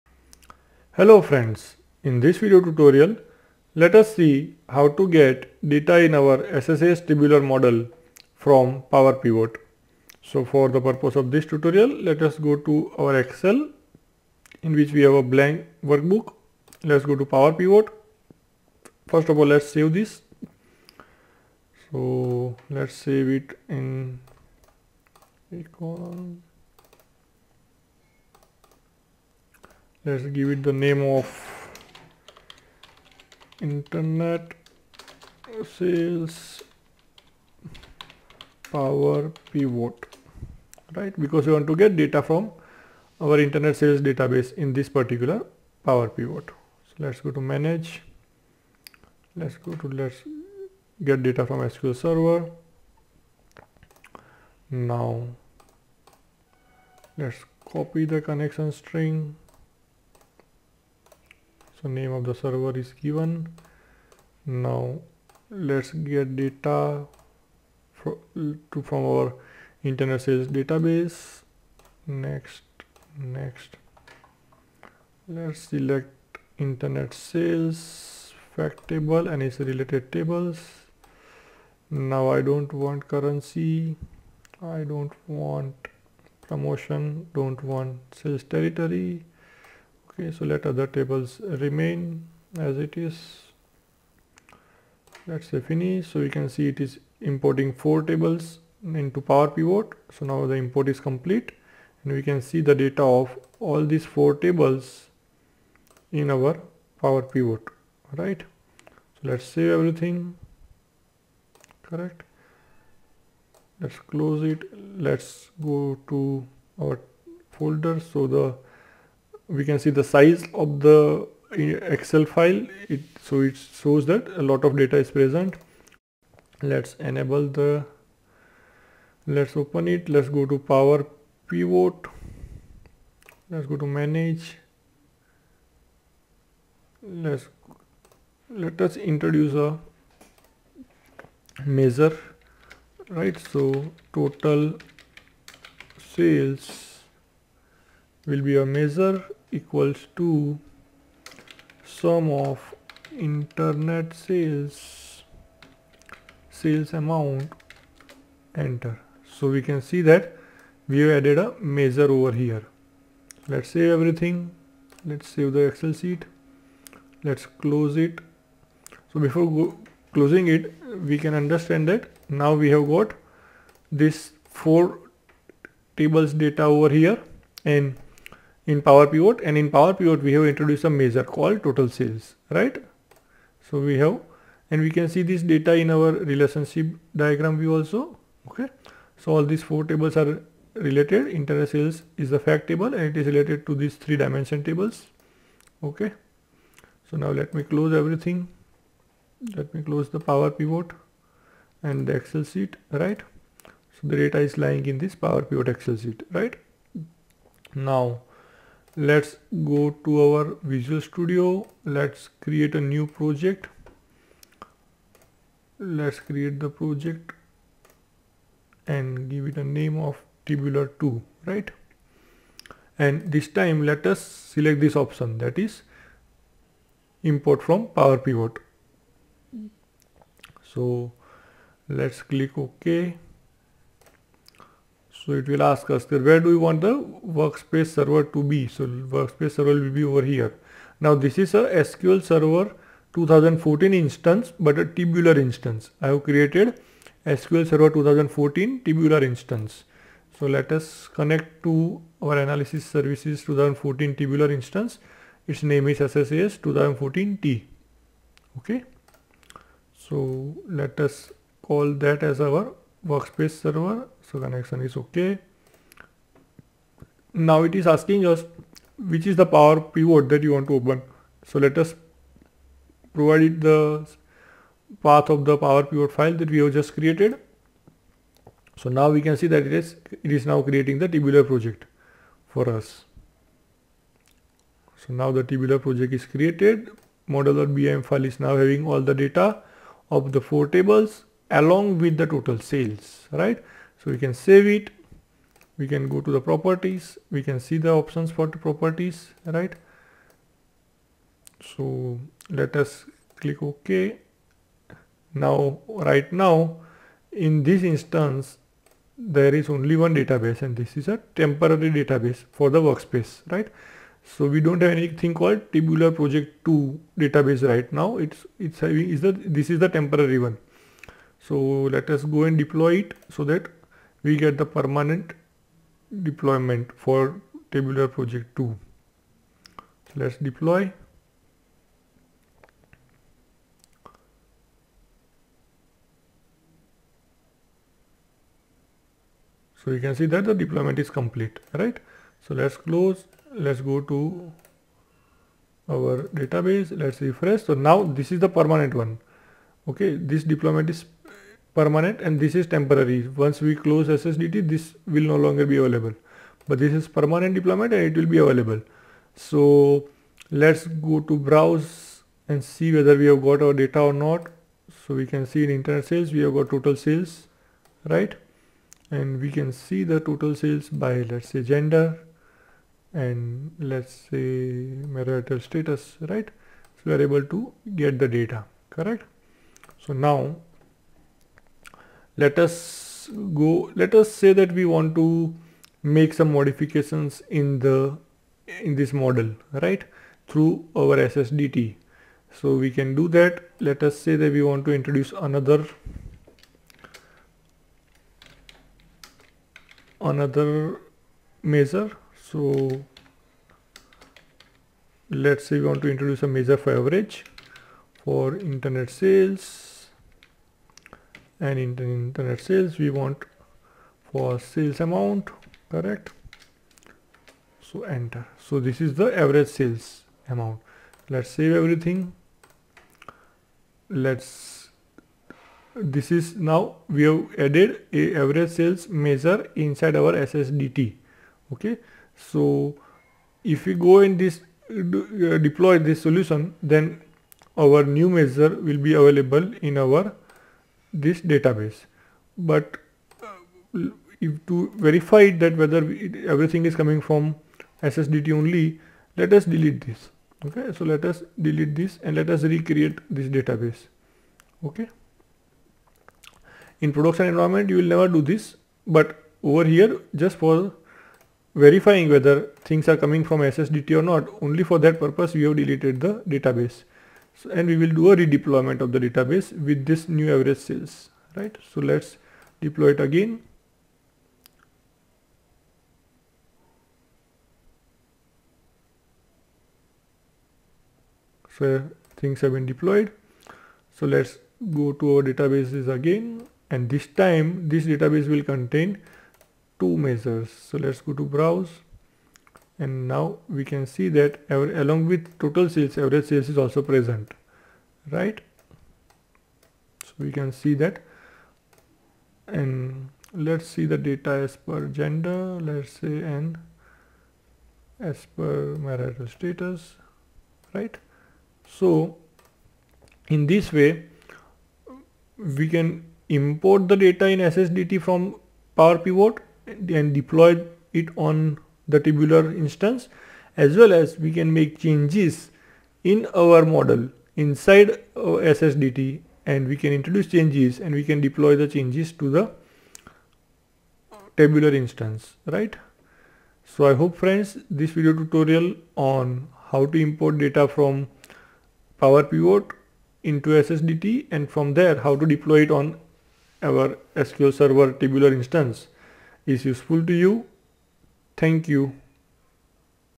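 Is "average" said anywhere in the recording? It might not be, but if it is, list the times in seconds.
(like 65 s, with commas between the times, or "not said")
406 s, 419 s, 428 s, 470 s, 496 s.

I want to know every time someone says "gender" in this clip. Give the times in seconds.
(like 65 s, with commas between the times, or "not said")
371 s, 505 s.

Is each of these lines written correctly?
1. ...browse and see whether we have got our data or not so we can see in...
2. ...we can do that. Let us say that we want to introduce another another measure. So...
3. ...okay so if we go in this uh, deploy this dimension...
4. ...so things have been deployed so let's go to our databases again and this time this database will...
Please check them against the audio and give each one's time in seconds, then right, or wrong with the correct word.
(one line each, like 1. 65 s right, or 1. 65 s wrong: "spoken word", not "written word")
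1. 361 s right
2. 392 s right
3. 431 s wrong: "solution", not "dimension"
4. 481 s right.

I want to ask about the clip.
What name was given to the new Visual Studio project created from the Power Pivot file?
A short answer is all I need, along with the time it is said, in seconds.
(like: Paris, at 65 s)
tabular 2, at 220 s.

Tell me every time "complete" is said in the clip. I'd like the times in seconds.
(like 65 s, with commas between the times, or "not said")
100 s, 341 s.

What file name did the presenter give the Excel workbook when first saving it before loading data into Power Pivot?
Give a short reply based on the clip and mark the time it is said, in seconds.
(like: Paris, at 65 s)
internet sales power pivot, at 33 s.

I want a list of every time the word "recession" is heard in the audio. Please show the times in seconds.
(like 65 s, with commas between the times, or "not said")
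not said.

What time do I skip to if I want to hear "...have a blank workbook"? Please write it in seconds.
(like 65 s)
15 s.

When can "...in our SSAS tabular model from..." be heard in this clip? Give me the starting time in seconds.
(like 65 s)
6 s.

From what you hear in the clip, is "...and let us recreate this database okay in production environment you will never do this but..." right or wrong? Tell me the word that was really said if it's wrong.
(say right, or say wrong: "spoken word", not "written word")
right.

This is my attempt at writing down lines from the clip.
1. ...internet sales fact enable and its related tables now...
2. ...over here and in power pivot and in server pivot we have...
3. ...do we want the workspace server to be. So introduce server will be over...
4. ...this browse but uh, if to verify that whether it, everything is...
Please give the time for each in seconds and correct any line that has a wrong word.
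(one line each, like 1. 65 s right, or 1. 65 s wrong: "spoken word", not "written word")
1. 76 s wrong: "table", not "enable"
2. 176 s wrong: "power", not "server"
3. 236 s wrong: "workspace", not "introduce"
4. 441 s wrong: "database", not "browse".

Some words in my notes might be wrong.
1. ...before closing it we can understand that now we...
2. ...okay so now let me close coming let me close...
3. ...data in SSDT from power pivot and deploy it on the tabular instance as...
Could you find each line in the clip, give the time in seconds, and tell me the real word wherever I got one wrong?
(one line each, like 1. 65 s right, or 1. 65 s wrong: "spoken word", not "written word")
1. 169 s right
2. 195 s wrong: "everything", not "coming"
3. 517 s right.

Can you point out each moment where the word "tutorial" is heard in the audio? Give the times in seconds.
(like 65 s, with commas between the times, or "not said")
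2 s, 11 s, 538 s.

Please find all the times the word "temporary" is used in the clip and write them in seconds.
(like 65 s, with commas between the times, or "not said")
311 s, 319 s, 352 s.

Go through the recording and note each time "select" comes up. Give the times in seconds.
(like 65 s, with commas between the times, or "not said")
75 s, 224 s.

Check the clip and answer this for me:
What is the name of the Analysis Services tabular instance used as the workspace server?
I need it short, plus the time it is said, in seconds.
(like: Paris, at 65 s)
SSAS 2014T, at 255 s.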